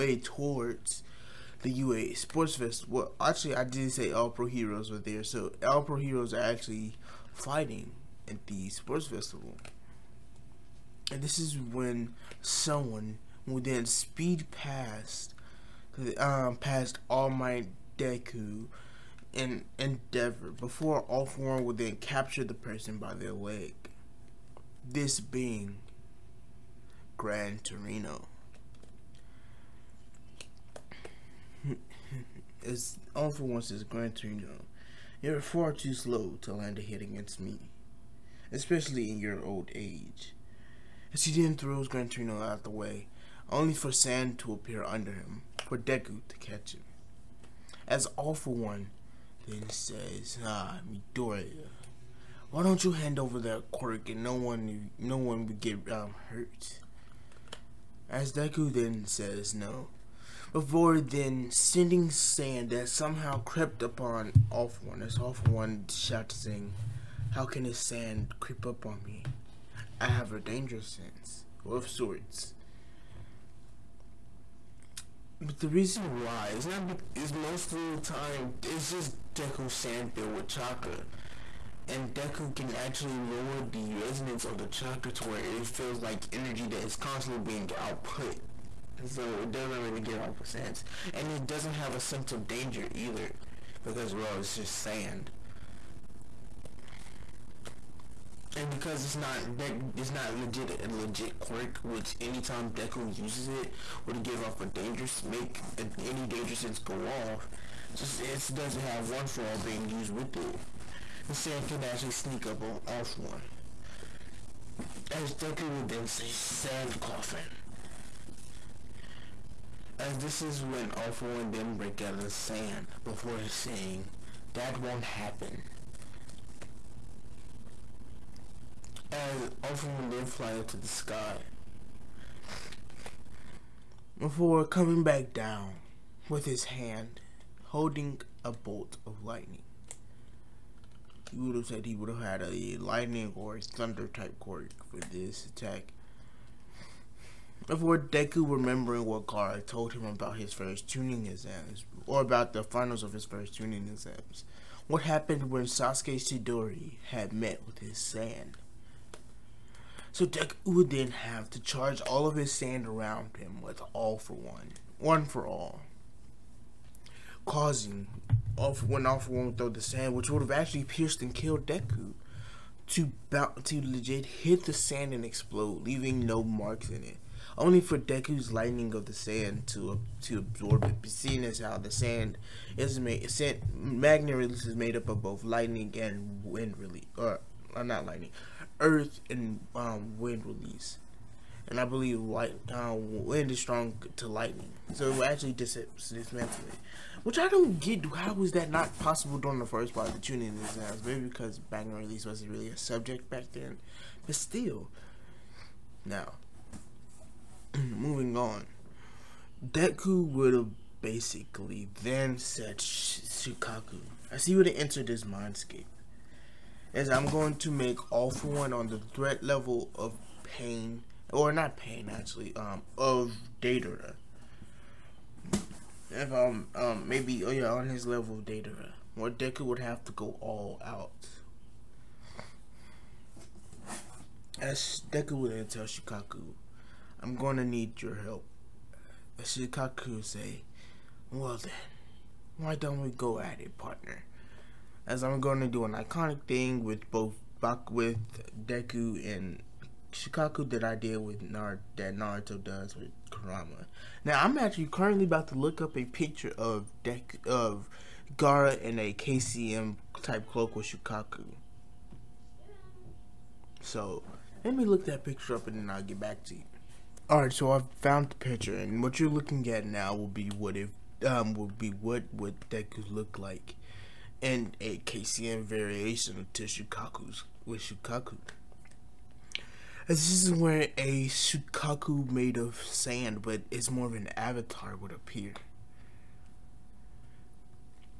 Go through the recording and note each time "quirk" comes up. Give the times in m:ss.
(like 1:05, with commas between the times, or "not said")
0:53, 1:41, 2:24.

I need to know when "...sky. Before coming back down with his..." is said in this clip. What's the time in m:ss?
2:10.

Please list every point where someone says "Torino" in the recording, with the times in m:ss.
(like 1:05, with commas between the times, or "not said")
0:27, 0:34, 0:42.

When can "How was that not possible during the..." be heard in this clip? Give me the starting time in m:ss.
3:18.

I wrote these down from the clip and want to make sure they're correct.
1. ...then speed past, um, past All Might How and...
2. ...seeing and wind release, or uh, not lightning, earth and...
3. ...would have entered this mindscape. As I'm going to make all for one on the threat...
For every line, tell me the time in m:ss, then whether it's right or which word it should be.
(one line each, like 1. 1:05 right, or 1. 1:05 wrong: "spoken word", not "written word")
1. 0:13 wrong: "Deku", not "How"
2. 3:05 wrong: "lightning", not "seeing"
3. 3:34 right.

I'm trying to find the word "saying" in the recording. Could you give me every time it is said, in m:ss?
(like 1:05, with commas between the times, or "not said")
1:06, 2:03.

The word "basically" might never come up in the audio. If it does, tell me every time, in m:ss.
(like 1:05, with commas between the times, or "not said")
3:31.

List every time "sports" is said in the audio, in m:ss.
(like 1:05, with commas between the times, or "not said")
0:02, 0:08.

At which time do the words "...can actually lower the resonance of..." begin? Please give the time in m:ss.
1:22.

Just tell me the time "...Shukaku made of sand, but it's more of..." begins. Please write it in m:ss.
4:41.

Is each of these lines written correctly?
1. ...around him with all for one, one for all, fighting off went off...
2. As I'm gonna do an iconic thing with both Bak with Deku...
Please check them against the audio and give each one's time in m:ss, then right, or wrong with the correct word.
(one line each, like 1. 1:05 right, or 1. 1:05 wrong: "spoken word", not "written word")
1. 2:42 wrong: "causing", not "fighting"
2. 4:05 right.